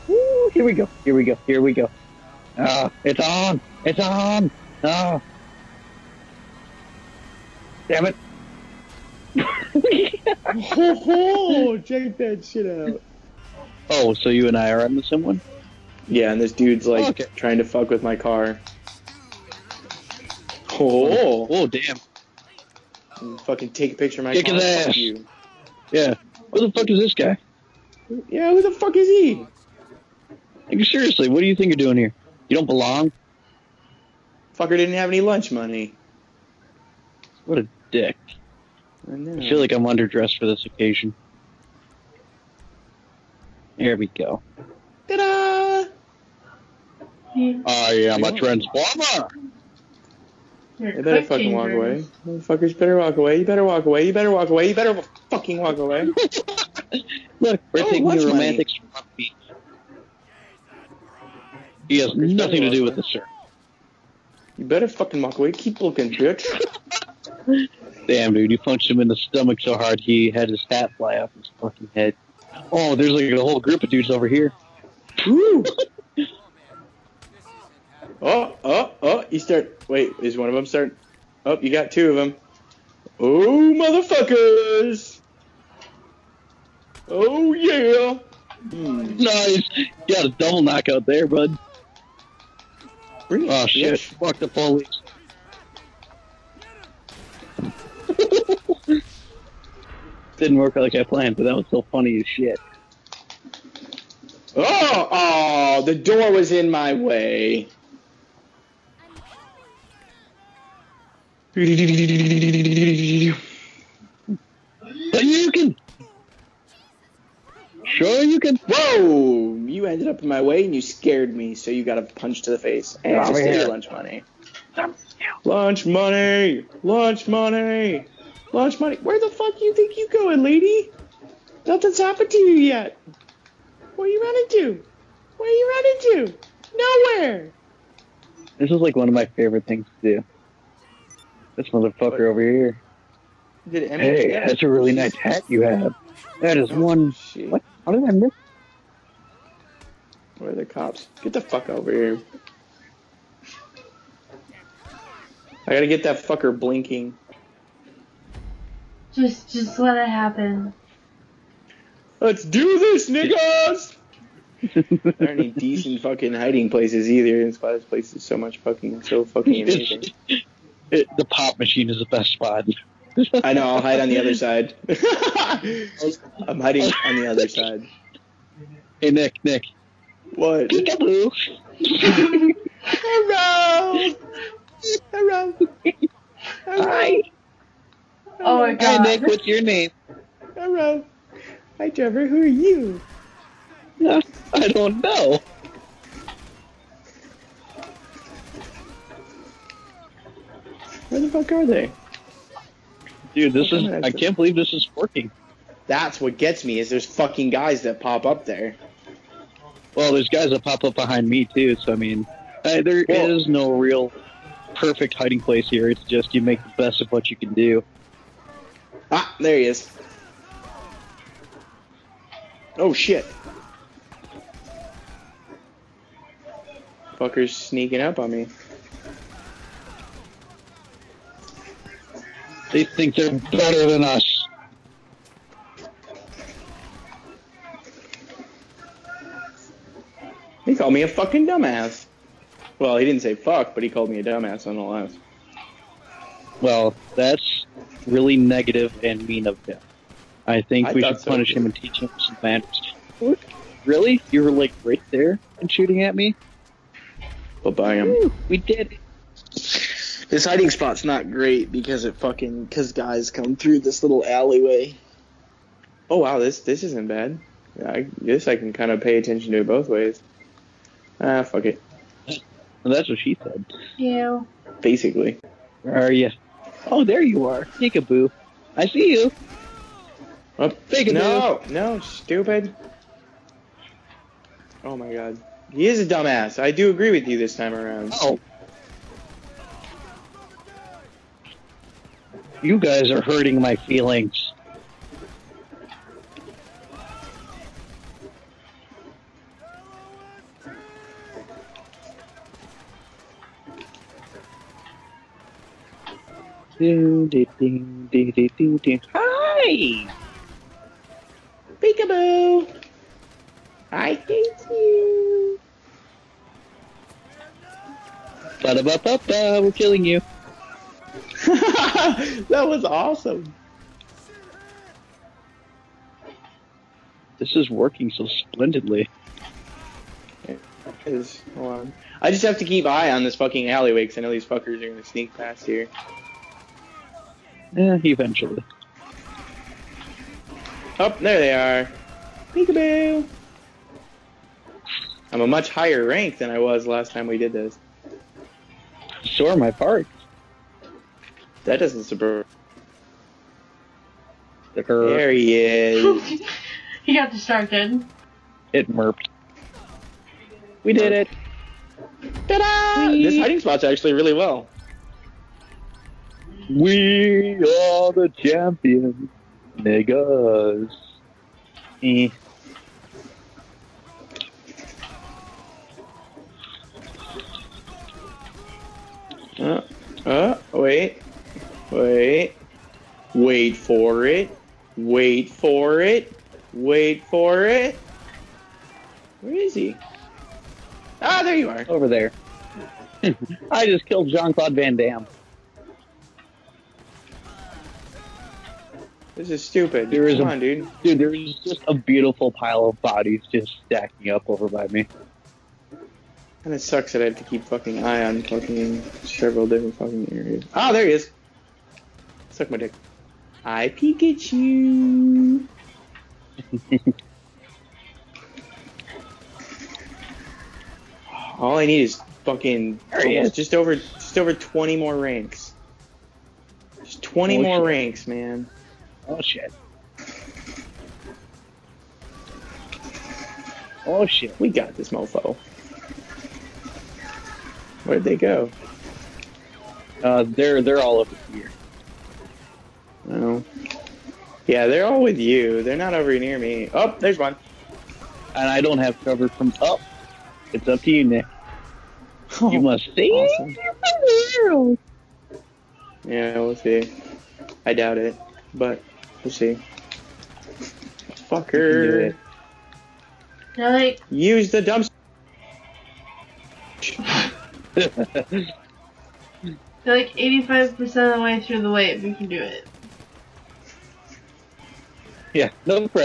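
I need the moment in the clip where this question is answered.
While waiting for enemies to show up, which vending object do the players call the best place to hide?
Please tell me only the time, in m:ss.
2:51.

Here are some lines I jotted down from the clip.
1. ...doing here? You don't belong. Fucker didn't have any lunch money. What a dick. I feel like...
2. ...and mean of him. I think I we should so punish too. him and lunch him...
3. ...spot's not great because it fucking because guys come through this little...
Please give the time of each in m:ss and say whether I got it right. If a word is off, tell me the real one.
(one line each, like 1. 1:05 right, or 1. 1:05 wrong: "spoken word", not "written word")
1. 0:31 right
2. 4:09 wrong: "teach", not "lunch"
3. 4:20 right.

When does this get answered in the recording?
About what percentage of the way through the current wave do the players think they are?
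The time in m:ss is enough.
7:50.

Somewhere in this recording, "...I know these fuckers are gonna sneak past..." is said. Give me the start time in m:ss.
5:34.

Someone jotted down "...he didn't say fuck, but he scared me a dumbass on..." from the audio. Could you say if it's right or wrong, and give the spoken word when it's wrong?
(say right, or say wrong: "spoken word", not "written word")
wrong: "called", not "scared".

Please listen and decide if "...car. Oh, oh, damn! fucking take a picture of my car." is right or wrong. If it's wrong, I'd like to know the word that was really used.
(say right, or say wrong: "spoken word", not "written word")
right.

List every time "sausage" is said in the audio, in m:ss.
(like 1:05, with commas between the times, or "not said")
not said.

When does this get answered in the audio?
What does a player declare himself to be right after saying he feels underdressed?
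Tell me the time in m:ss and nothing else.
0:48.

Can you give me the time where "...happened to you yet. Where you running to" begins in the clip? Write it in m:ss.
2:11.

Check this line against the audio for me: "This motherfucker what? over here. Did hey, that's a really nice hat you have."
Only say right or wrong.
right.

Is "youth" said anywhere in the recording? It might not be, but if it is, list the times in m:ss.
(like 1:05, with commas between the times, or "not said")
not said.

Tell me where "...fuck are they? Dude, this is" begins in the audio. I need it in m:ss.
3:21.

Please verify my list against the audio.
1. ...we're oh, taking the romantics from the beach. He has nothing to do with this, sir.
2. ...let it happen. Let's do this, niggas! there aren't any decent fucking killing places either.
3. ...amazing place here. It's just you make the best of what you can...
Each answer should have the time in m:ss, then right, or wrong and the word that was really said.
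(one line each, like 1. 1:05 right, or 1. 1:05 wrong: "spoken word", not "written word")
1. 0:57 right
2. 2:39 wrong: "hiding", not "killing"
3. 3:35 wrong: "hiding", not "amazing".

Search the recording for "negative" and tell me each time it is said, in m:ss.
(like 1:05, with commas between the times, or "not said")
4:08.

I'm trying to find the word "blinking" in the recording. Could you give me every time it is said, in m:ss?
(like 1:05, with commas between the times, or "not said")
2:36.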